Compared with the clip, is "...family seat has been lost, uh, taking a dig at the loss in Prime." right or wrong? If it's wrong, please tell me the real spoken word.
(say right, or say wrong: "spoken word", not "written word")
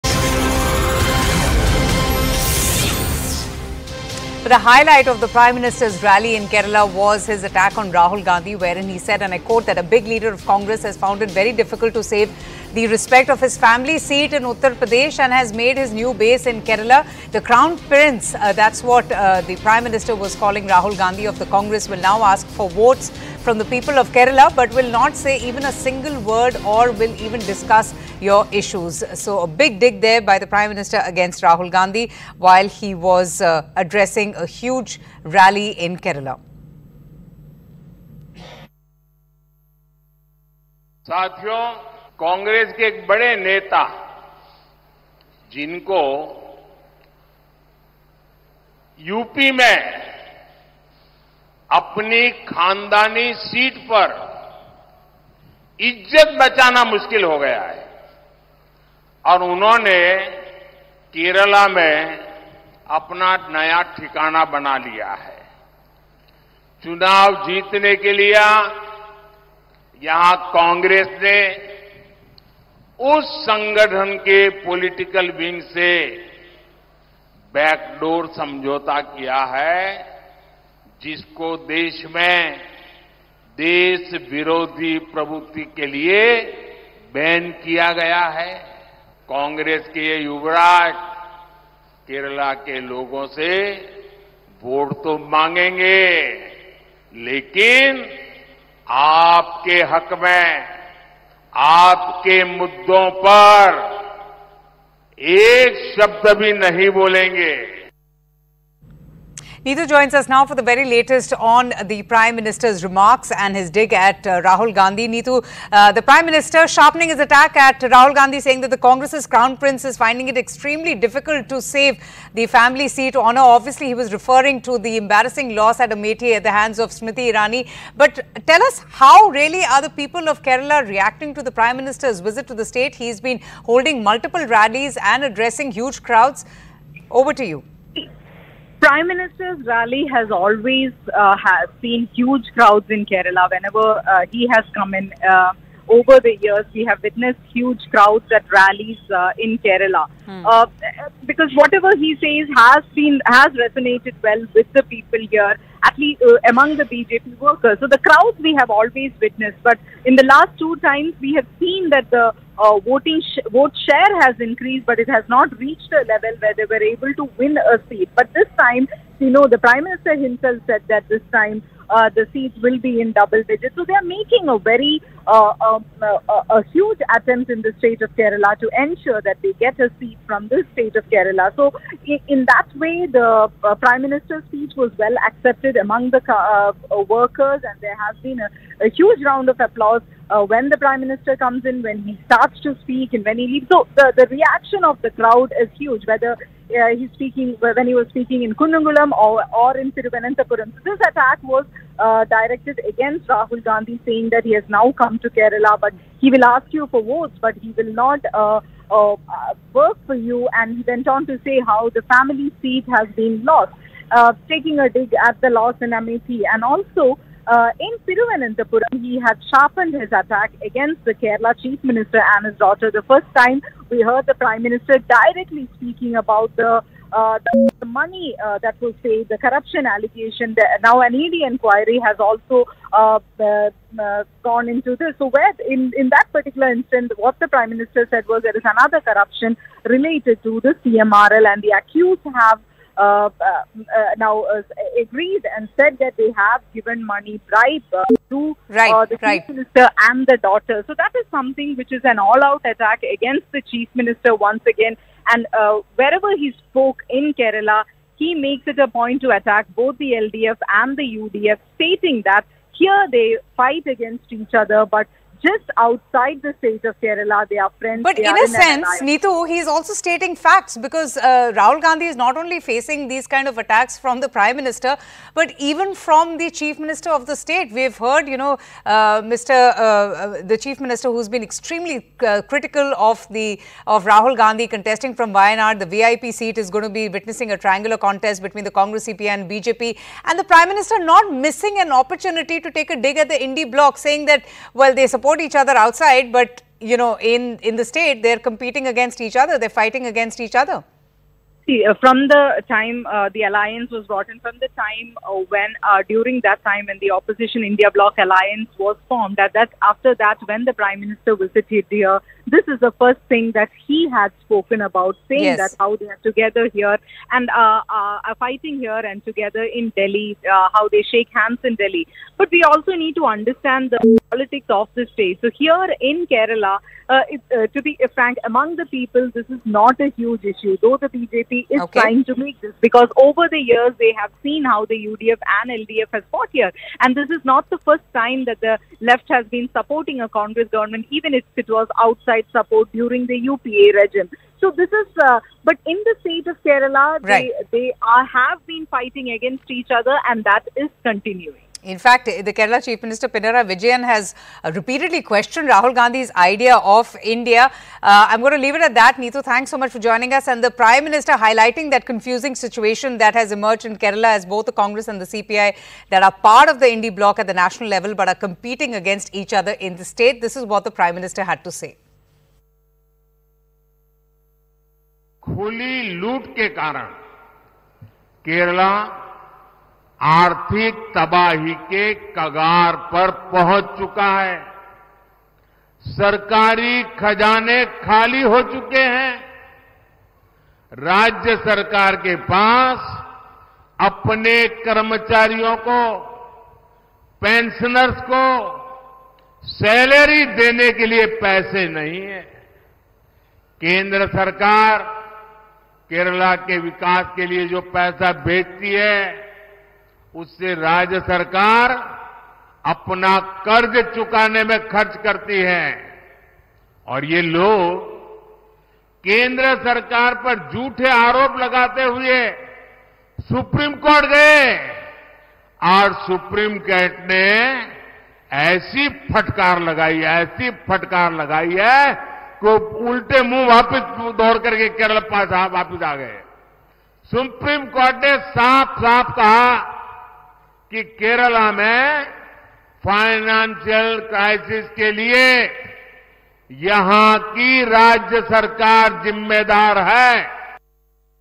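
wrong: "MAP", not "Prime".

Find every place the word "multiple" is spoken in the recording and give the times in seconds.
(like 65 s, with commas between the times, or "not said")
134 s.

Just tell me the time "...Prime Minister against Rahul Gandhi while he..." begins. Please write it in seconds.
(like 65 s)
30 s.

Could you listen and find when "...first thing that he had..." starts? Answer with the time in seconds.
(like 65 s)
312 s.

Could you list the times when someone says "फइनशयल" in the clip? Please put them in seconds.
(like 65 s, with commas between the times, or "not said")
443 s.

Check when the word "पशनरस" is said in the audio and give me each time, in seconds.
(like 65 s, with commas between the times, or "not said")
397 s.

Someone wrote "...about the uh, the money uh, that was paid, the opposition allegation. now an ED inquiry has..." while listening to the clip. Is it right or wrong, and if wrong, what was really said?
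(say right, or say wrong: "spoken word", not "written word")
wrong: "corruption", not "opposition".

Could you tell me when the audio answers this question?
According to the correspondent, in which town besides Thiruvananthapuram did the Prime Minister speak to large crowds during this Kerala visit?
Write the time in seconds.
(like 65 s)
198 s.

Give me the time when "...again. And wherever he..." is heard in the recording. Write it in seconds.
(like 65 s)
254 s.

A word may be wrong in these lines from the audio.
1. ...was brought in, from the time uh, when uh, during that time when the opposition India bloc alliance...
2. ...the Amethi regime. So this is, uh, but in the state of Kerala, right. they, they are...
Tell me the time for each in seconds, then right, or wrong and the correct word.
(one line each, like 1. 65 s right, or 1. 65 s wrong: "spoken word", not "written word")
1. 303 s right
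2. 343 s wrong: "UPA", not "Amethi".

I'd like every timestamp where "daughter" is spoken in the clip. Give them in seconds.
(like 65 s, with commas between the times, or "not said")
222 s, 250 s.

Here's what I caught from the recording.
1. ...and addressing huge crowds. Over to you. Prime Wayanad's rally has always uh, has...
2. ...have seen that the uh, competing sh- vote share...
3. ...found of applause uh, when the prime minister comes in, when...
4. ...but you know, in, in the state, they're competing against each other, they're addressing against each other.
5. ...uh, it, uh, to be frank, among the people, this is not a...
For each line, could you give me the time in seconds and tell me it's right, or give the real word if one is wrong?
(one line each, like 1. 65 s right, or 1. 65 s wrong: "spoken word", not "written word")
1. 135 s wrong: "Minister", not "Wayanad"
2. 161 s wrong: "voting", not "competing"
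3. 189 s wrong: "round", not "found"
4. 296 s wrong: "fighting", not "addressing"
5. 327 s right.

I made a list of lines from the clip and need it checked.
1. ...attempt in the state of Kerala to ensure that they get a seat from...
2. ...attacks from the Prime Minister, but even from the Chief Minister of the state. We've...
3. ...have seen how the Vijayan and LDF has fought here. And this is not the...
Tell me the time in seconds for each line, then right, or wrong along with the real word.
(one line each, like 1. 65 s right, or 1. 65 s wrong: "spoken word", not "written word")
1. 177 s right
2. 273 s right
3. 334 s wrong: "UDF", not "Vijayan".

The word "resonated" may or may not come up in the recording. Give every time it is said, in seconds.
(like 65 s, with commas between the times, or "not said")
153 s.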